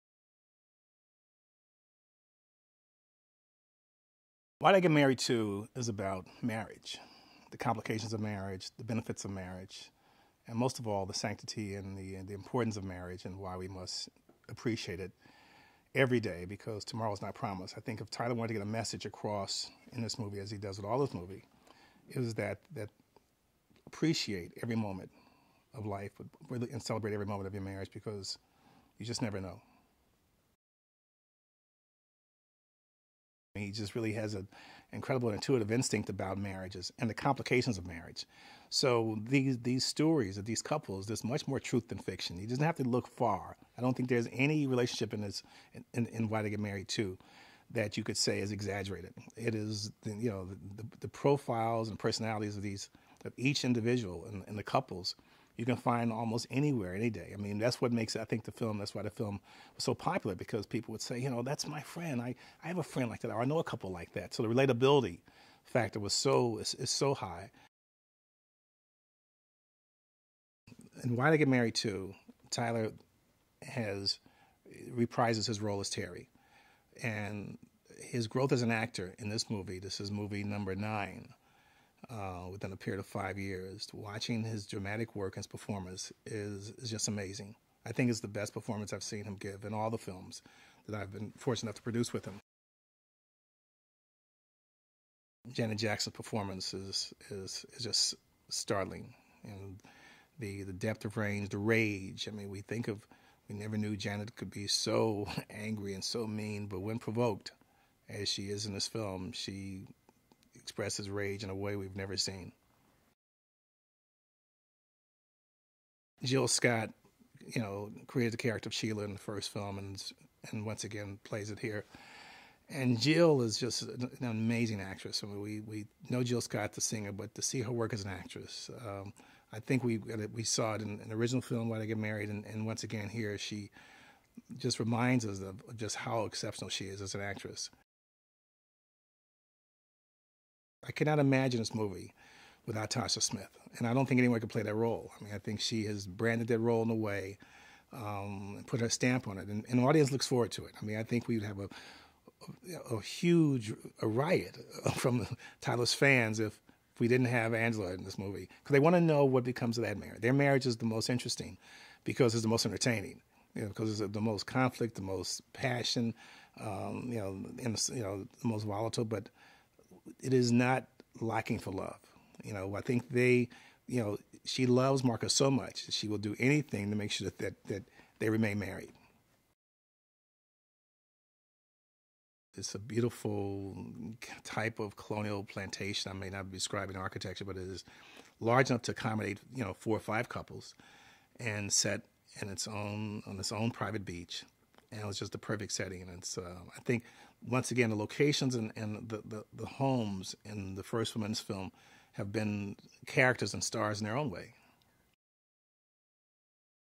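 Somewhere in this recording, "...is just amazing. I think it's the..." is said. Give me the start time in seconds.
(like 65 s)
86 s.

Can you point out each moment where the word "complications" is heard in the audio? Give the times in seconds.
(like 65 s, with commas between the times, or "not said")
7 s, 37 s.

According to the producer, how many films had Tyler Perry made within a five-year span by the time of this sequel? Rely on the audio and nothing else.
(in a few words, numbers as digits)
9.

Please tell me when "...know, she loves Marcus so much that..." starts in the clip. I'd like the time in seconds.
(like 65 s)
174 s.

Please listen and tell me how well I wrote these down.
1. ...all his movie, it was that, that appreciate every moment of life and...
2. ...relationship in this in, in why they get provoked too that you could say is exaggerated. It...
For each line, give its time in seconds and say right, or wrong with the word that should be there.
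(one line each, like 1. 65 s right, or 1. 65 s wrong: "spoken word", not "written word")
1. 20 s right
2. 44 s wrong: "married", not "provoked".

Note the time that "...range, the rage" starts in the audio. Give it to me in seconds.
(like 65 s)
101 s.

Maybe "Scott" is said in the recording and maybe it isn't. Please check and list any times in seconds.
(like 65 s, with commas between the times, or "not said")
116 s, 126 s.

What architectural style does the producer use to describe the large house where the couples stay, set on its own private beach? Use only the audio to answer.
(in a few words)
Colonial plantation.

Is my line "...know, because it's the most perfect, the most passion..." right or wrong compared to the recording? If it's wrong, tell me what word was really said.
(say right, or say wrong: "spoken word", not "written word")
wrong: "conflict", not "perfect".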